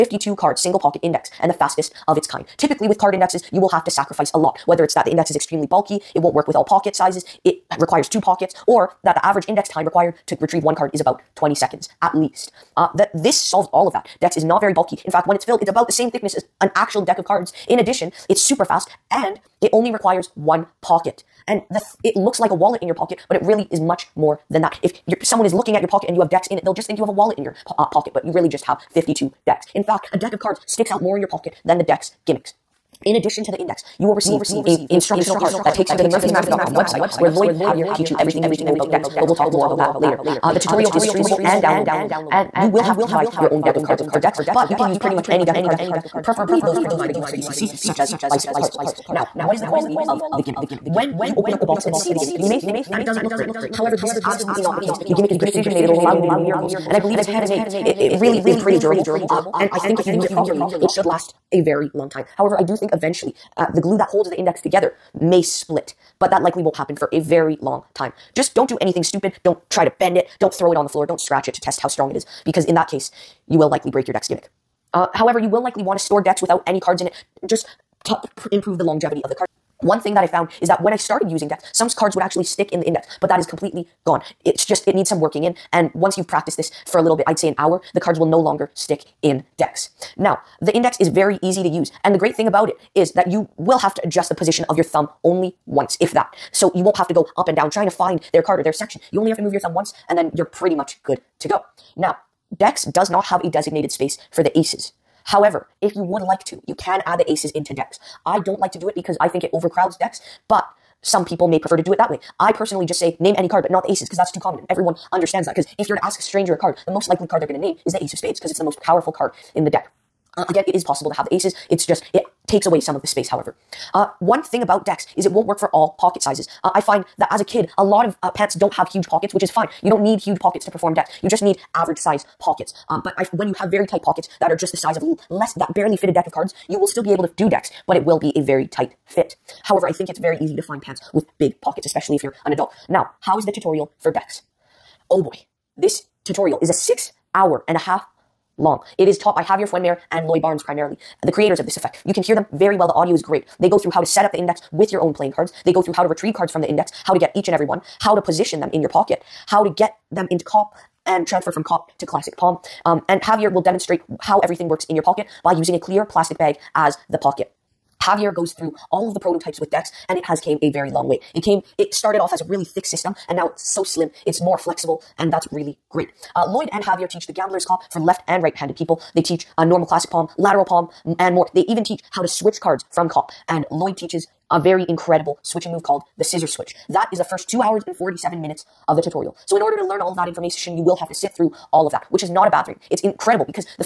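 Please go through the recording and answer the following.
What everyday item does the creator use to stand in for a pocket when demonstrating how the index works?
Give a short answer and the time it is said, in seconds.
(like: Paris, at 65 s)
clear plastic bag, at 165 s.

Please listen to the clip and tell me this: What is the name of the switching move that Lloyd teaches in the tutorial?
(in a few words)
scissor switch.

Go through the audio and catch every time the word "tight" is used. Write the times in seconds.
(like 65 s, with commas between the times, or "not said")
133 s, 138 s.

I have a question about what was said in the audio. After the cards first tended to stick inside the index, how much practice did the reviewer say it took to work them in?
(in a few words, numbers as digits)
an hour.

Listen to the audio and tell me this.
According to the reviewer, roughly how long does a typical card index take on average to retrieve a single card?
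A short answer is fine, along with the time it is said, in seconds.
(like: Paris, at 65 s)
20 seconds, at 11 s.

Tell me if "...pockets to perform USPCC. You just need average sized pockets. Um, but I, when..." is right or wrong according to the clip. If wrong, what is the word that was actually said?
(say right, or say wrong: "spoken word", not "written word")
wrong: "Dex", not "USPCC".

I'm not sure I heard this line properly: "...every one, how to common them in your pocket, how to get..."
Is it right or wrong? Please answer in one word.
wrong.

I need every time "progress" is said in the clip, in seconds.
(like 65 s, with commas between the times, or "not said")
not said.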